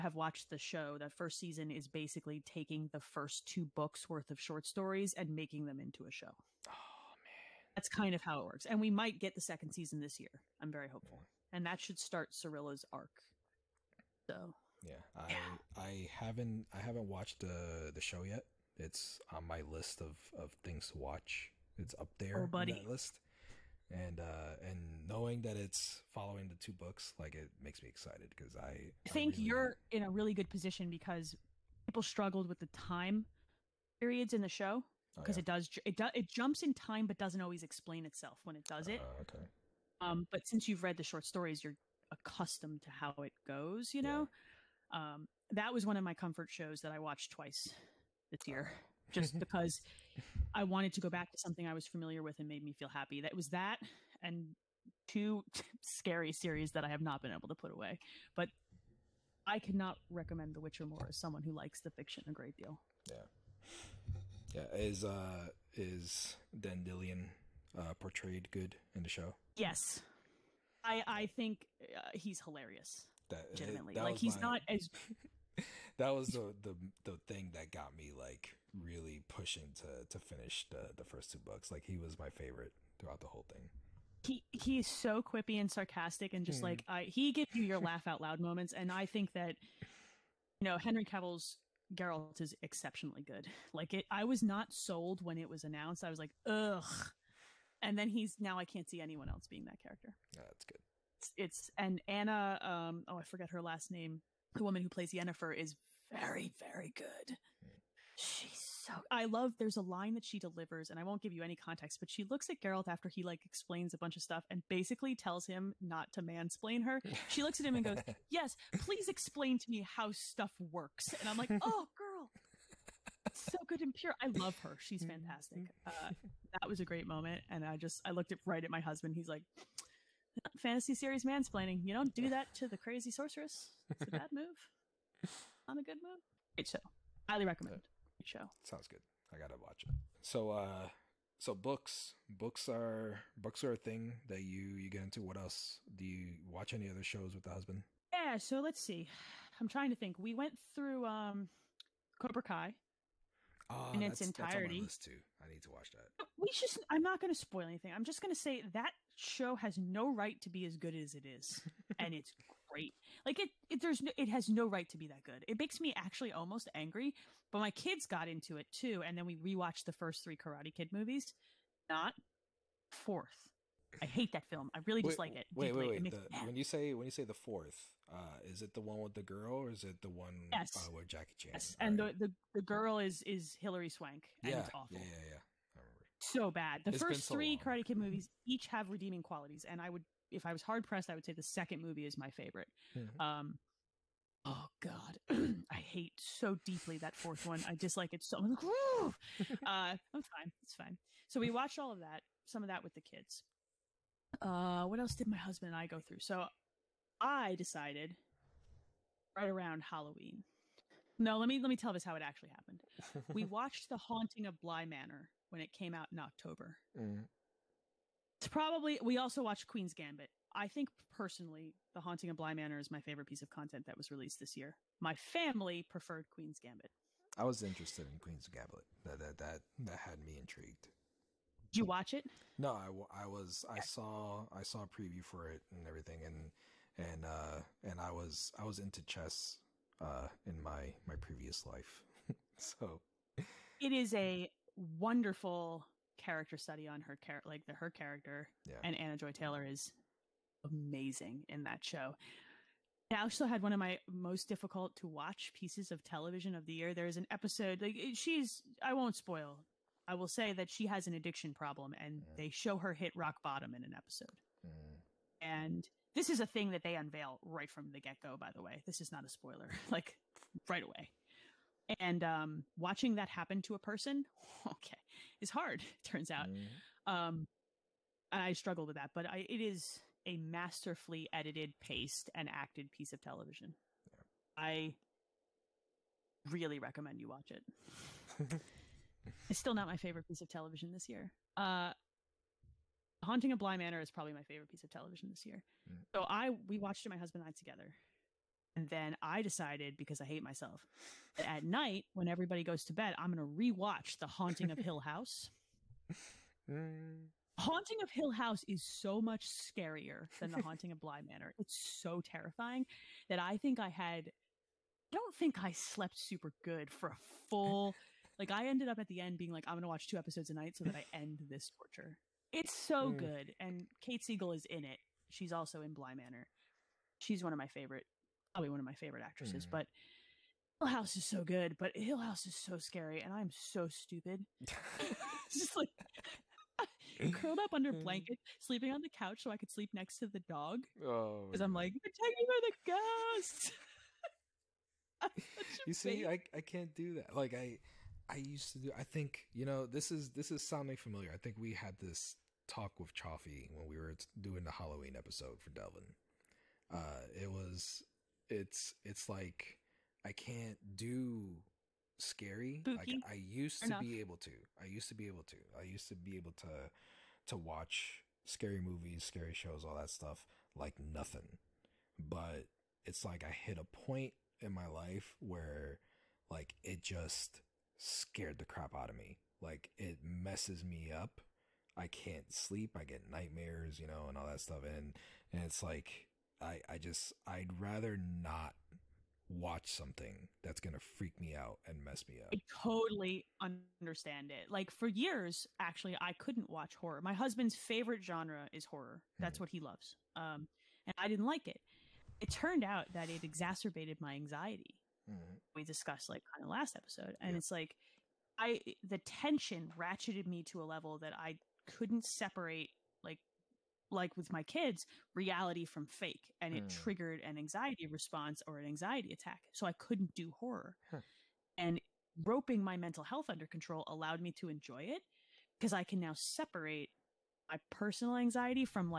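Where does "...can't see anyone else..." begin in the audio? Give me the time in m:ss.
1:38.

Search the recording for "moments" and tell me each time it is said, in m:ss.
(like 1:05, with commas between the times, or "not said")
1:28, 2:07.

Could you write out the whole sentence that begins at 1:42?
Um, oh, I forget her last name.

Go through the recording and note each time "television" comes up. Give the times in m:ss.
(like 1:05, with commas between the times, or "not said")
4:16, 4:43, 4:50, 4:54.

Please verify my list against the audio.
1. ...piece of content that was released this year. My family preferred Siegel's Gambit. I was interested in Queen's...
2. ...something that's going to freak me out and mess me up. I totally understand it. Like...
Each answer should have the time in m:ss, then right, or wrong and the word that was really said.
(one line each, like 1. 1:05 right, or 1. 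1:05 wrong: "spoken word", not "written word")
1. 3:43 wrong: "Queen", not "Siegel"
2. 6:29 right.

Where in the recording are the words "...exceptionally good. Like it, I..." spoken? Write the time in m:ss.
1:32.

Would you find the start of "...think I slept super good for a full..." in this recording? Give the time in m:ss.
5:15.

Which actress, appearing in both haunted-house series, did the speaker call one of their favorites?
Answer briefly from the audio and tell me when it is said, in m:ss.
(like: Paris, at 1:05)
Kate Siegel, at 5:24.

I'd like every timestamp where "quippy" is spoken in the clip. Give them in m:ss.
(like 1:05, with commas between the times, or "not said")
1:25.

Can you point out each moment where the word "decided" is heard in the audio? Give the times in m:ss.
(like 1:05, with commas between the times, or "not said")
3:27, 4:59.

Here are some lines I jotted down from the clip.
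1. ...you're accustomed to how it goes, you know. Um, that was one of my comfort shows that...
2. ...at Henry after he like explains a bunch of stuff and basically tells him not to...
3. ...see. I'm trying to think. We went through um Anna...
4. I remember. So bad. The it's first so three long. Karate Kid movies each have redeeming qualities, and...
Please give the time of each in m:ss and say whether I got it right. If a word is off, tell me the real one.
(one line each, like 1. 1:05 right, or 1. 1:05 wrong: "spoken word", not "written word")
1. 0:41 right
2. 1:52 wrong: "Geralt", not "Henry"
3. 2:28 wrong: "Cobra", not "Anna"
4. 3:05 right.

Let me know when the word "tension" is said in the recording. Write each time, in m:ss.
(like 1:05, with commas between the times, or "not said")
6:49.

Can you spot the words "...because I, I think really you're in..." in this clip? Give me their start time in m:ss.
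0:28.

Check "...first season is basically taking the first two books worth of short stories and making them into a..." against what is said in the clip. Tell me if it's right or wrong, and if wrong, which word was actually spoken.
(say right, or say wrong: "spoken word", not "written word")
right.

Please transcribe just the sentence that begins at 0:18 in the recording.
It's on my list of of things to watch.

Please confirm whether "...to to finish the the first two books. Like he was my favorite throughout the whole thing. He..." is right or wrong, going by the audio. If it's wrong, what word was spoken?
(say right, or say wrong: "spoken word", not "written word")
right.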